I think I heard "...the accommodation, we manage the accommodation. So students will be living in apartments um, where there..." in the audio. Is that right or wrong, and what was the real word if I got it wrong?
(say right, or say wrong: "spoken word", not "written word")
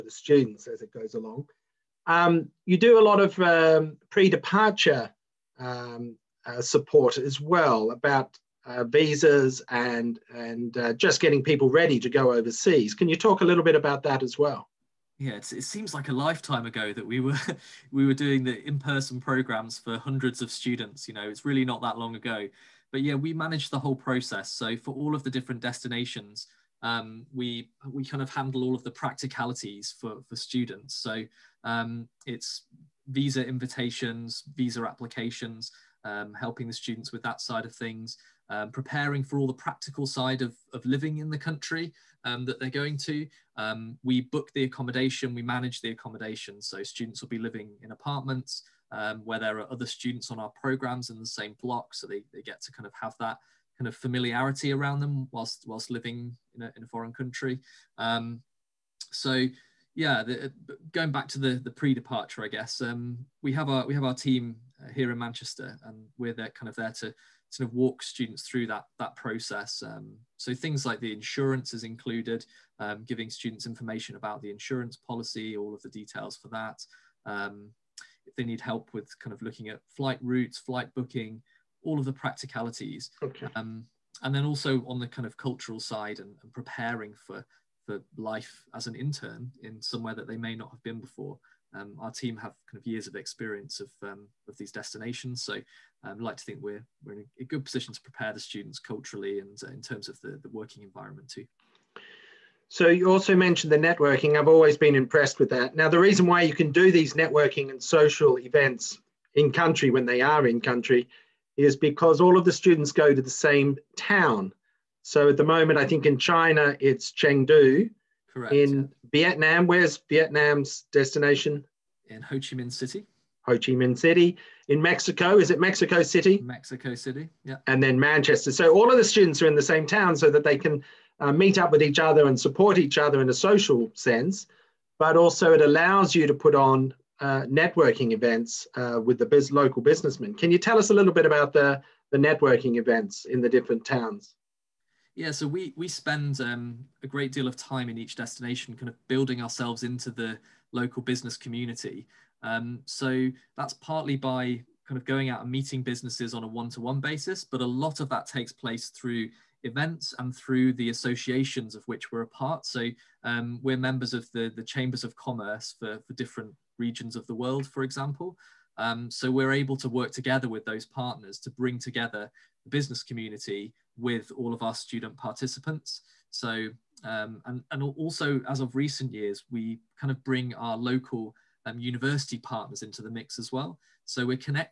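right.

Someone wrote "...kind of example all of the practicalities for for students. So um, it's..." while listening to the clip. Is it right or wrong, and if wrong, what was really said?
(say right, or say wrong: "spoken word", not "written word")
wrong: "handle", not "example".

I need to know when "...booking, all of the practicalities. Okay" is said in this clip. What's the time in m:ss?
1:20.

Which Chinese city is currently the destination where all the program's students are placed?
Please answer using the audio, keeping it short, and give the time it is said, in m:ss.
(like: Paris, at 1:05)
Chengdu, at 1:57.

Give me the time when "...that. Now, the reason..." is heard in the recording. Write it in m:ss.
1:45.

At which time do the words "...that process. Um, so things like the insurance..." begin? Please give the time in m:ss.
1:08.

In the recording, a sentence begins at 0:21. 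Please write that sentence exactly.
You know, it's really not that long ago.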